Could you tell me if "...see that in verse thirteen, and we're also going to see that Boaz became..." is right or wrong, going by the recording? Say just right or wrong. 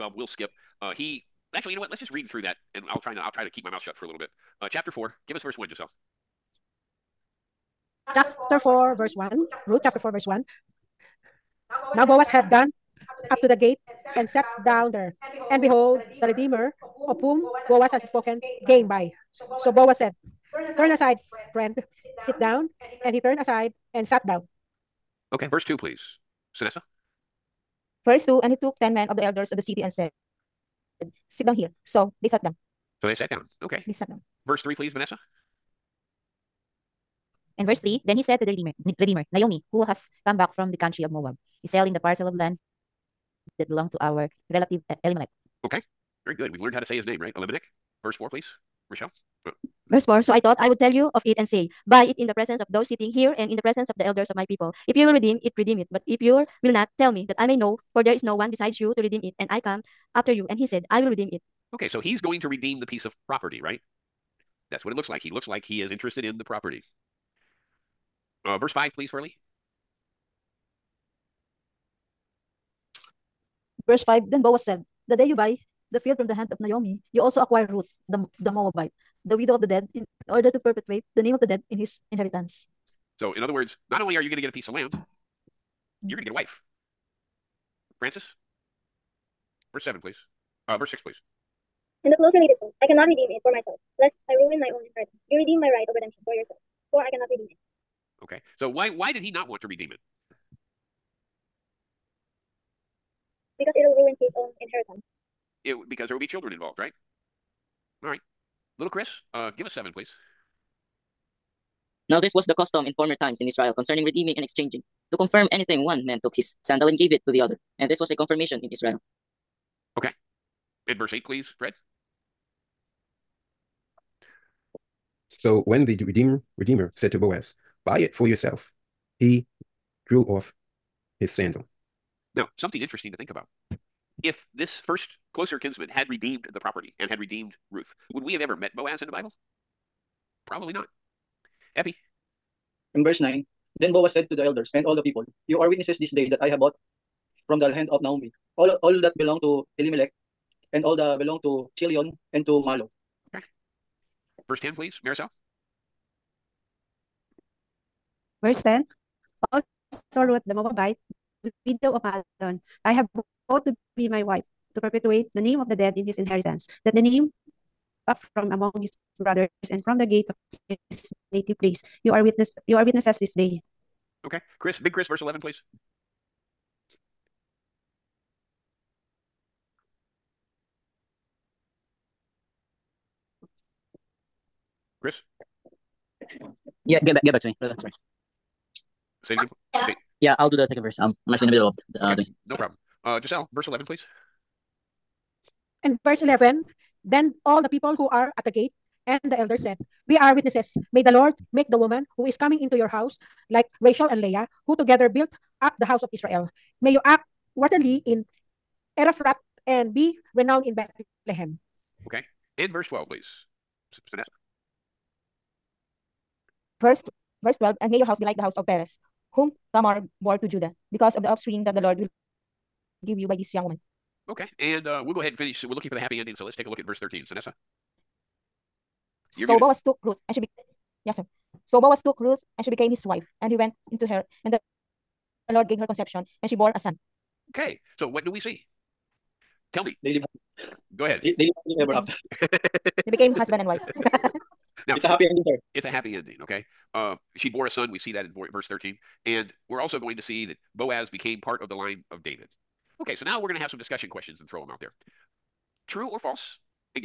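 right.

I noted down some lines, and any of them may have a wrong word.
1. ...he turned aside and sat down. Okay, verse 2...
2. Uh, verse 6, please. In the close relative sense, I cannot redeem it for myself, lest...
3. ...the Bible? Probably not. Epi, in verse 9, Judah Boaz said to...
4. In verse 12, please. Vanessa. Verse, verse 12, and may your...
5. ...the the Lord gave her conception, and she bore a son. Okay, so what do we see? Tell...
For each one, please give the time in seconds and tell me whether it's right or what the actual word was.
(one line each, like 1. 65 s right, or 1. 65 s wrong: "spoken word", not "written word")
1. 23 s right
2. 90 s right
3. 139 s wrong: "Then", not "Judah"
4. 212 s right
5. 234 s right.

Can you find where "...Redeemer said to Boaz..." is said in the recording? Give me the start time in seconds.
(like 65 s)
126 s.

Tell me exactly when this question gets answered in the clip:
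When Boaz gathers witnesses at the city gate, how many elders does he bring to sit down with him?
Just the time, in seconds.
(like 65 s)
28 s.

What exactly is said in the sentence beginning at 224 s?
Okay, and uh, we'll go ahead and finish.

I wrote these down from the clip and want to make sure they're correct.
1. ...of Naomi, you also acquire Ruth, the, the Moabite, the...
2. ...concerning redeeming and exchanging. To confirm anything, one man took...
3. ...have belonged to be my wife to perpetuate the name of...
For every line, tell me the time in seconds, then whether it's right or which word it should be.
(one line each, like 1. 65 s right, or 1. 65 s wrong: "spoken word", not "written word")
1. 76 s right
2. 113 s right
3. 162 s wrong: "vowed", not "belonged".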